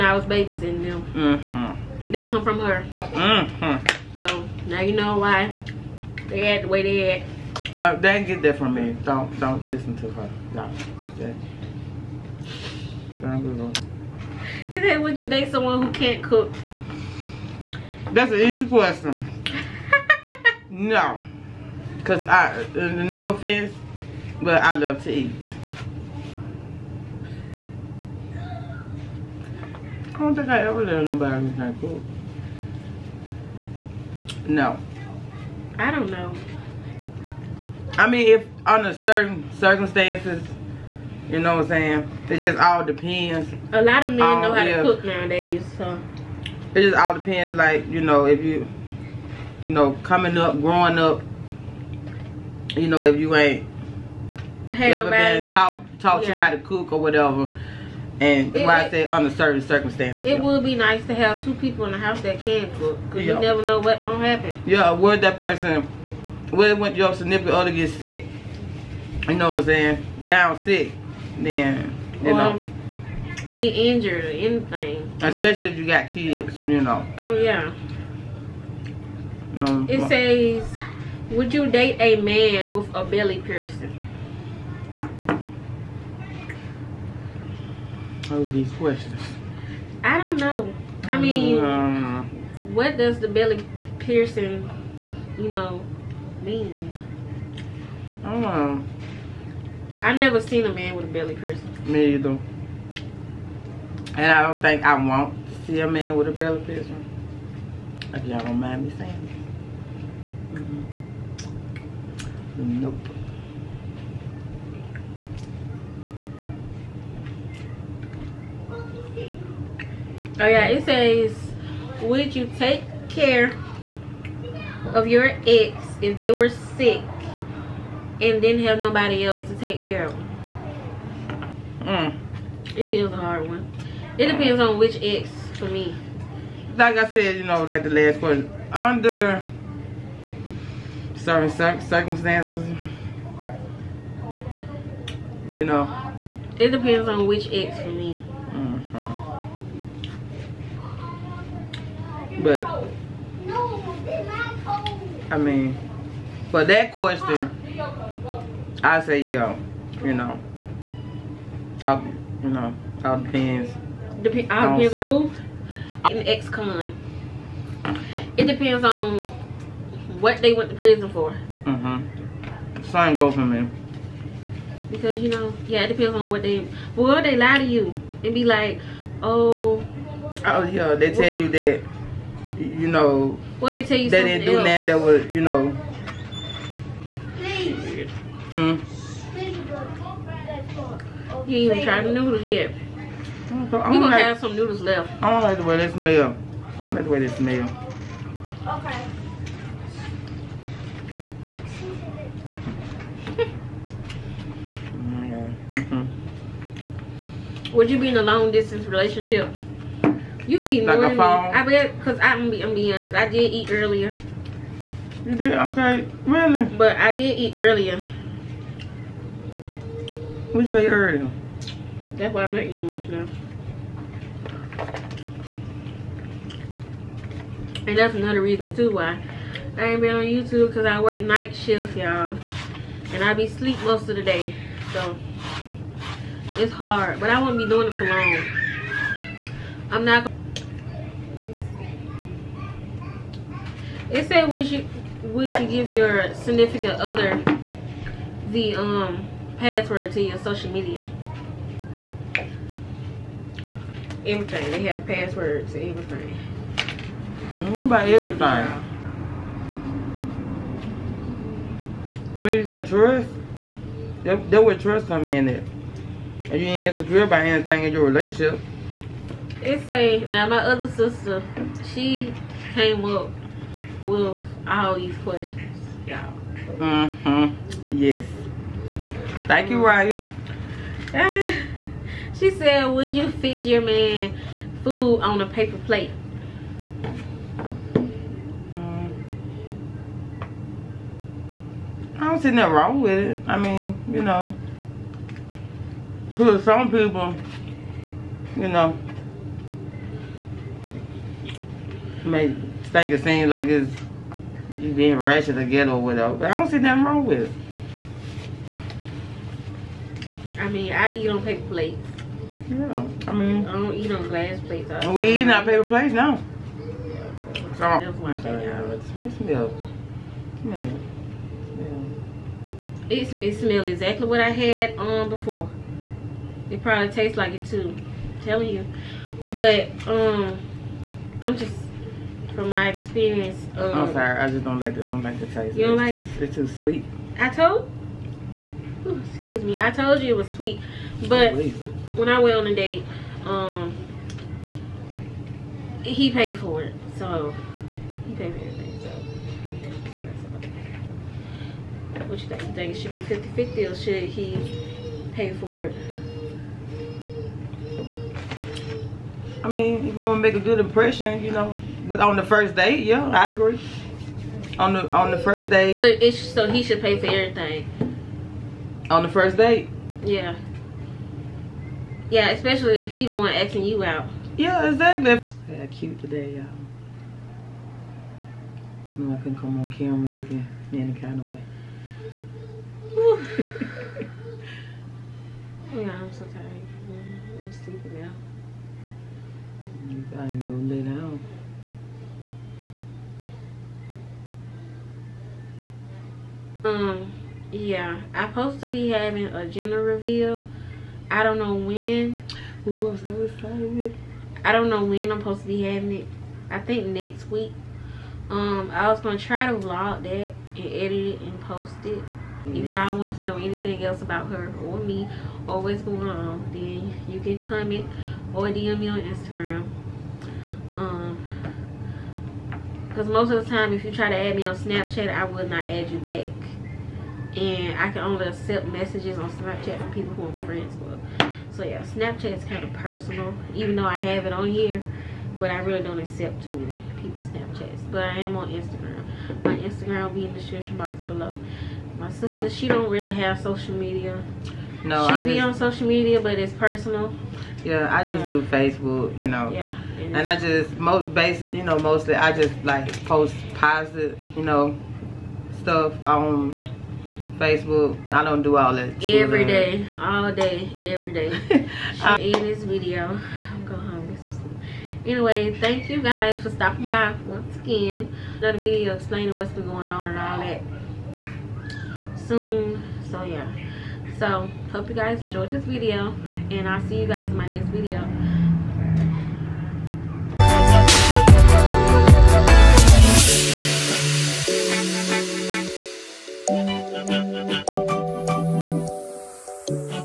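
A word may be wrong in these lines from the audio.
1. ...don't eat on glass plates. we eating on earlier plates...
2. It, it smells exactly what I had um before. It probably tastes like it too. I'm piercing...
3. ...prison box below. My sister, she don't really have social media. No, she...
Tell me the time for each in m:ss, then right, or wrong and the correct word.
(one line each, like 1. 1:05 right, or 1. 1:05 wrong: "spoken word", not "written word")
1. 5:13 wrong: "paper", not "earlier"
2. 5:23 wrong: "telling", not "piercing"
3. 7:20 wrong: "description", not "prison".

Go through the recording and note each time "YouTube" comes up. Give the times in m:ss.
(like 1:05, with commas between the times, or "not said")
3:50.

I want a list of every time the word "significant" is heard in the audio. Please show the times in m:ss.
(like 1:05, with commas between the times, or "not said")
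1:07, 4:06.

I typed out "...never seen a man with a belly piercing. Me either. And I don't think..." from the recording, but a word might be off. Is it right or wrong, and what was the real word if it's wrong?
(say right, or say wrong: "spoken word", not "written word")
right.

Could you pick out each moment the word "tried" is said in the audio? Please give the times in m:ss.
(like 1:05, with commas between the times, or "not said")
3:11.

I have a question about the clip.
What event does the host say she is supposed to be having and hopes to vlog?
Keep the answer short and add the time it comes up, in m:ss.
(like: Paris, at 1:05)
Gender reveal, at 6:39.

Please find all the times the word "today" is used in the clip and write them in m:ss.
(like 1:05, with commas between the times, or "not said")
6:16.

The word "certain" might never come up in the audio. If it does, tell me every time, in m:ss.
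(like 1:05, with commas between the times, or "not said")
0:38, 0:59, 2:21.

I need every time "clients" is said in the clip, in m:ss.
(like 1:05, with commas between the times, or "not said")
not said.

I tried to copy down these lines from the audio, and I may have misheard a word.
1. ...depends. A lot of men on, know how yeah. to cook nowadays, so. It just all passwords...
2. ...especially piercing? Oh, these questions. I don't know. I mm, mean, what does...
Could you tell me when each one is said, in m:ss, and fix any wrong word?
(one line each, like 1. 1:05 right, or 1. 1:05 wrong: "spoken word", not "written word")
1. 0:42 wrong: "depends", not "passwords"
2. 1:23 wrong: "belly", not "especially".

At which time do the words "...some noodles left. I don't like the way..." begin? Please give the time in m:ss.
3:14.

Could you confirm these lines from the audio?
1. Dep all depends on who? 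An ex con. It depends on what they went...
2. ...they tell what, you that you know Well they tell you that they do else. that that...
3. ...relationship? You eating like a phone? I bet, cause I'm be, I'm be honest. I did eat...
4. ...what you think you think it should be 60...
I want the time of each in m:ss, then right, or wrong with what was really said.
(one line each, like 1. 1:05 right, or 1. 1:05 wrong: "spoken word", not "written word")
1. 2:44 right
2. 3:00 right
3. 3:28 right
4. 5:52 wrong: "50", not "60".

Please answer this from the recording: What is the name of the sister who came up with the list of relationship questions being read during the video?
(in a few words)
Raya.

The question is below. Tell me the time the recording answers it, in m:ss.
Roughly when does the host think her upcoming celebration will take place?
6:47.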